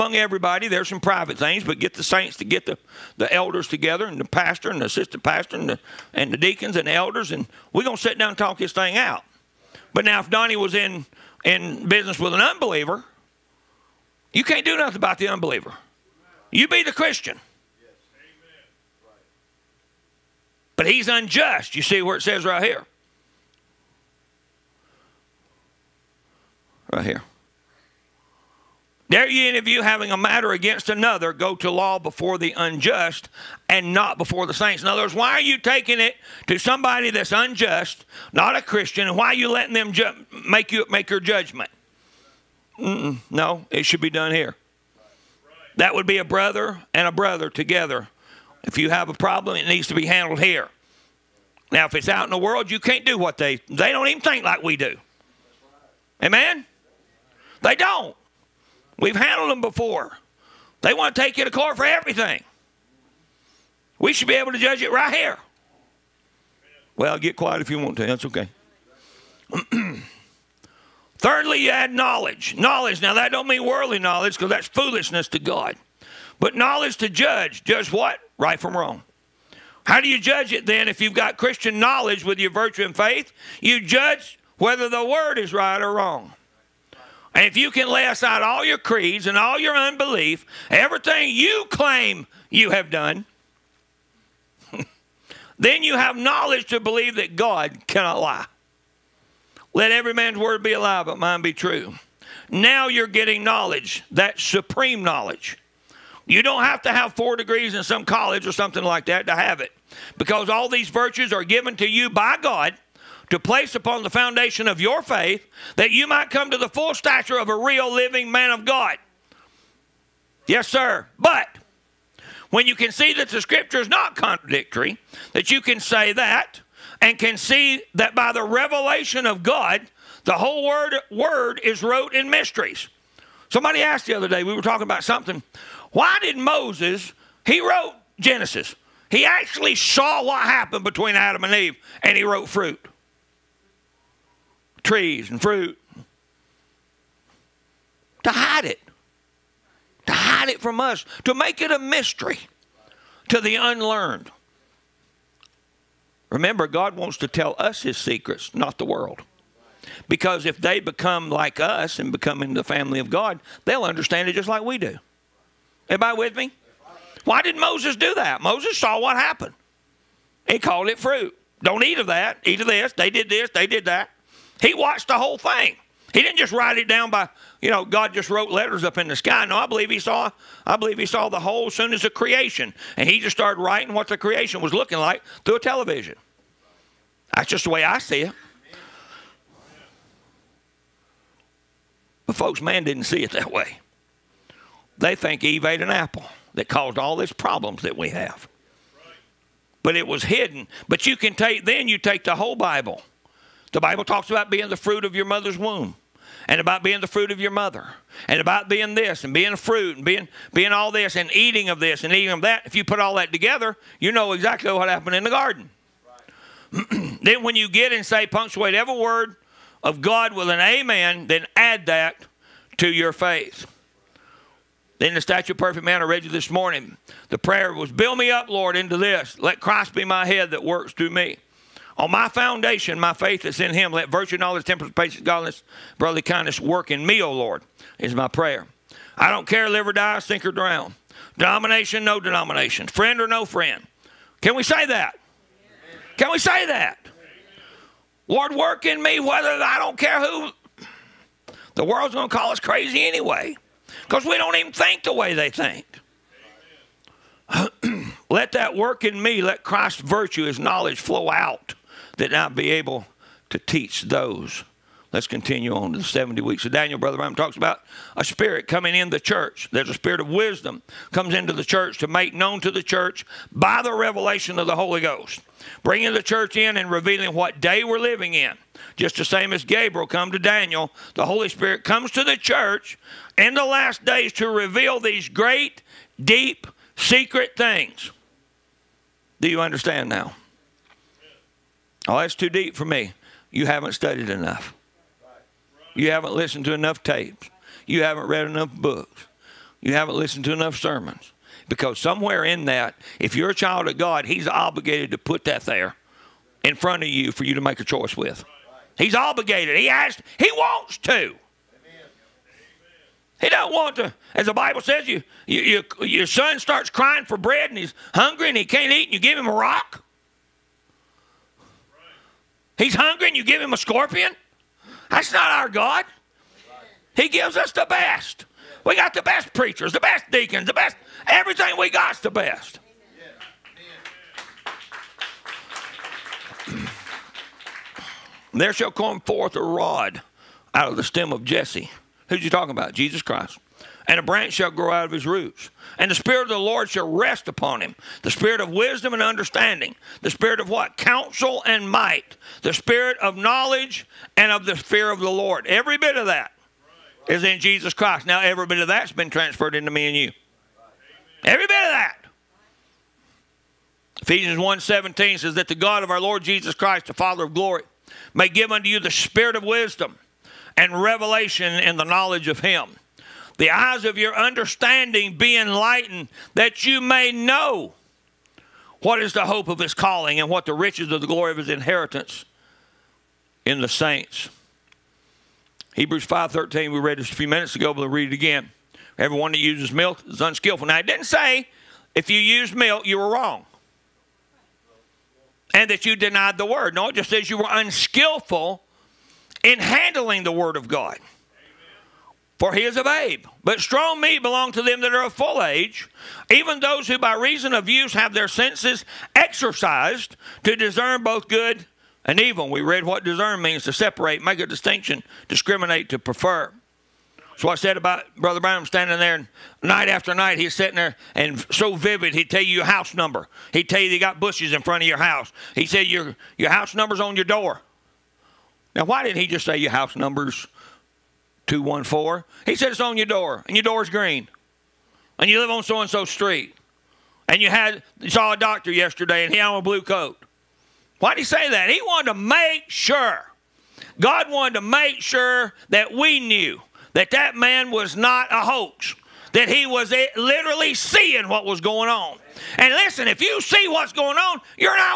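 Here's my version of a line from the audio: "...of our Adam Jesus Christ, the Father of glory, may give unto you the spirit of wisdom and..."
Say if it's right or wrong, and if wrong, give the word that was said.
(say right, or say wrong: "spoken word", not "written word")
wrong: "Lord", not "Adam".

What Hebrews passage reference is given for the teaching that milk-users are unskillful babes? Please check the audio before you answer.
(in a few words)
Hebrews 5:13.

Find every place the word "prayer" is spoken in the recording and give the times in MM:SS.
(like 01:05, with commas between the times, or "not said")
03:47, 03:58.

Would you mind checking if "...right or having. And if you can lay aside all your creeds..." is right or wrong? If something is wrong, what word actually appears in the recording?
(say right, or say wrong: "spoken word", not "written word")
wrong: "wrong", not "having".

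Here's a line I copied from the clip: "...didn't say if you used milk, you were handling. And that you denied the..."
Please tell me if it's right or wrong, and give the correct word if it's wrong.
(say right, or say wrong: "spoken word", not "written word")
wrong: "wrong", not "handling".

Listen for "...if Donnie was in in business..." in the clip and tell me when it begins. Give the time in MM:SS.
00:10.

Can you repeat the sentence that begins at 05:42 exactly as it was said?
Jesus Christ and a branch shall grow out of his roots.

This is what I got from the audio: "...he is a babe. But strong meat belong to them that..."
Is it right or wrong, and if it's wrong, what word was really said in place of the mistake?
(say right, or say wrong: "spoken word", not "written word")
right.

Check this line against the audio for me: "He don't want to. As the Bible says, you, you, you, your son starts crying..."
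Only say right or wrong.
right.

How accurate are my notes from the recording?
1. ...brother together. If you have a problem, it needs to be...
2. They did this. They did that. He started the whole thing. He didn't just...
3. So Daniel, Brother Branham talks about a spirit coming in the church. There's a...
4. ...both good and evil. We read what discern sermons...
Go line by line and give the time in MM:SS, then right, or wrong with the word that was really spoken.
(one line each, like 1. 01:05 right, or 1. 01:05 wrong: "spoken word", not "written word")
1. 00:47 right
2. 02:52 wrong: "watched", not "started"
3. 04:26 right
4. 06:51 wrong: "means", not "sermons".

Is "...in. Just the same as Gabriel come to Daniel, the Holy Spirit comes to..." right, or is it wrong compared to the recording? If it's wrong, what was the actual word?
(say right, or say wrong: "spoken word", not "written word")
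right.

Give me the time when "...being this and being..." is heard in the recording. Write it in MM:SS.
03:28.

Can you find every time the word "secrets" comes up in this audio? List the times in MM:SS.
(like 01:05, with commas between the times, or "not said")
02:37, 04:46.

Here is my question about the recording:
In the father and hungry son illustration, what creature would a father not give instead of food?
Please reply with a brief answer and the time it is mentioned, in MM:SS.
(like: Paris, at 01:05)
A scorpion, at 05:23.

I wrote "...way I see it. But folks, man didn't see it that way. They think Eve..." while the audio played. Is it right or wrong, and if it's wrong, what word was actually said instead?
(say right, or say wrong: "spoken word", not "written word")
right.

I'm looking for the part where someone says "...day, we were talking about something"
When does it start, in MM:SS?
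02:14.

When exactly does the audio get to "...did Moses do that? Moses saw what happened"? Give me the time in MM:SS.
02:47.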